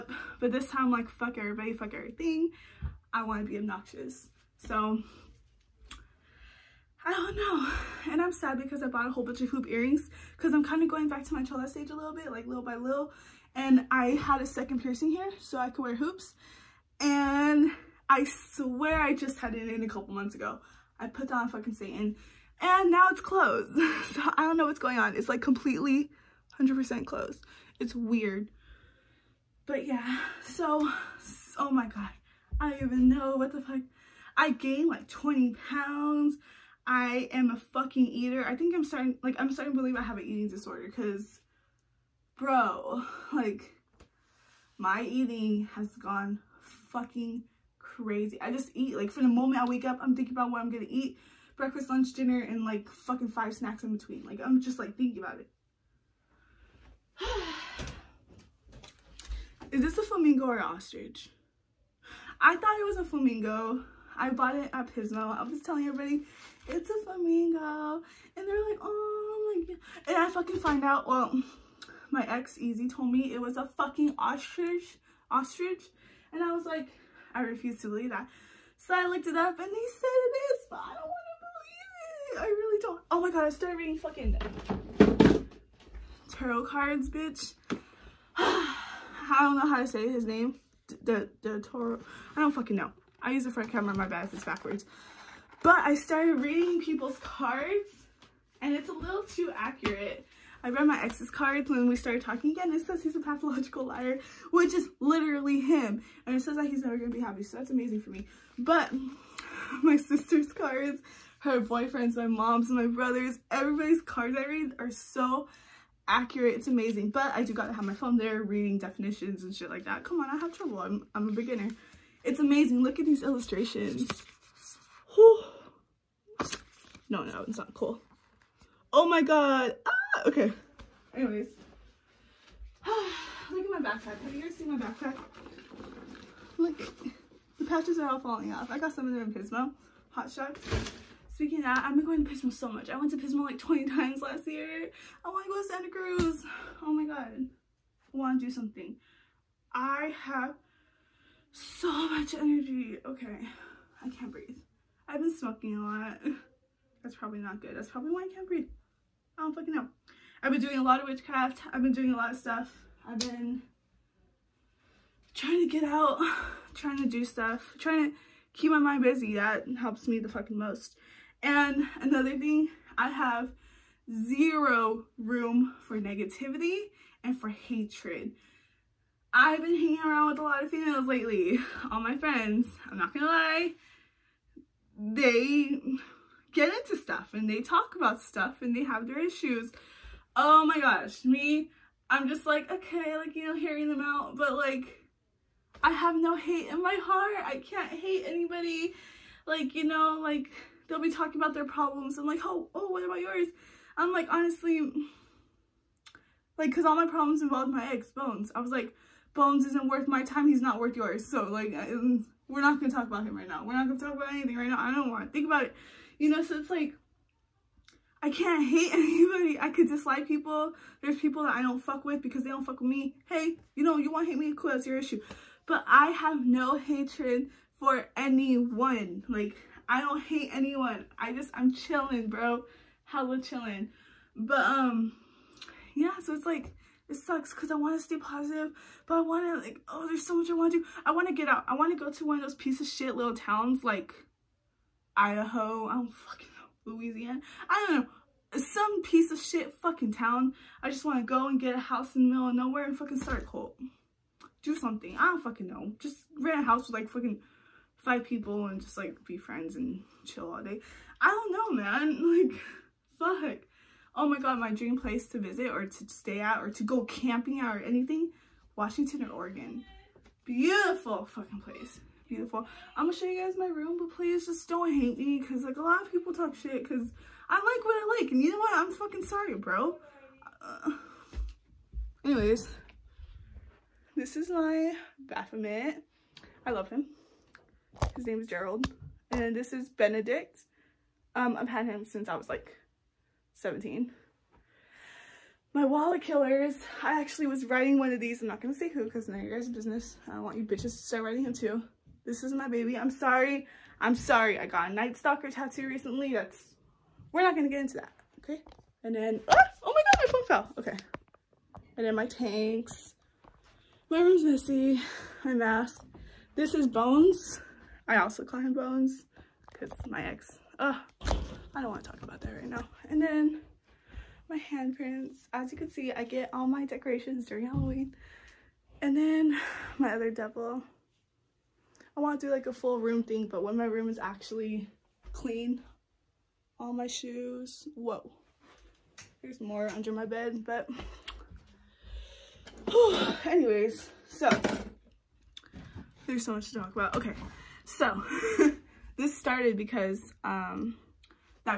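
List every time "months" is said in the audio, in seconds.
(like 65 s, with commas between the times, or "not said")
20 s.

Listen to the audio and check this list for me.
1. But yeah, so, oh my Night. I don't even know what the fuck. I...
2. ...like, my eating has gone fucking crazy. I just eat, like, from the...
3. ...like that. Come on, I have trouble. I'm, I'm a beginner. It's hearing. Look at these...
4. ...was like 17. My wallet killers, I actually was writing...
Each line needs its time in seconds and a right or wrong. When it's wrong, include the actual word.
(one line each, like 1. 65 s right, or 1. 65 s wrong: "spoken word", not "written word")
1. 29 s wrong: "God", not "Night"
2. 43 s right
3. 119 s wrong: "amazing", not "hearing"
4. 292 s right.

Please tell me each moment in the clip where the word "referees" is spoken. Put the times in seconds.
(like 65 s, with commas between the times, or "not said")
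not said.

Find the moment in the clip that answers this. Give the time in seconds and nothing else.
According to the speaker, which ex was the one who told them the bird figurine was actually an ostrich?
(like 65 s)
72 s.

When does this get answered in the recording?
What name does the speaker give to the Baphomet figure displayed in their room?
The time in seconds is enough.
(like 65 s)
288 s.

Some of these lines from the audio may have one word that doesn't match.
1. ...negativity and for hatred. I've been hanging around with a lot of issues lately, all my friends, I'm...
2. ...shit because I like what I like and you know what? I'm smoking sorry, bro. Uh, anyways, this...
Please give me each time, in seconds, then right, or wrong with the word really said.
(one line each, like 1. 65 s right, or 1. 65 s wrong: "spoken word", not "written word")
1. 176 s wrong: "females", not "issues"
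2. 276 s wrong: "fucking", not "smoking".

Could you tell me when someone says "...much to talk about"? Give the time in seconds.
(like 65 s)
346 s.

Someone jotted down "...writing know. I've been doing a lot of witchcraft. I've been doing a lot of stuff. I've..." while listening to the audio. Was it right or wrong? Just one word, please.
wrong.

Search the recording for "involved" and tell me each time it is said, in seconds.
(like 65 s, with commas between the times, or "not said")
207 s.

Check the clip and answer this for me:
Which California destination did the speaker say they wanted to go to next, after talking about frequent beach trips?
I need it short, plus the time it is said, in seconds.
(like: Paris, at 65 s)
Santa Cruz, at 145 s.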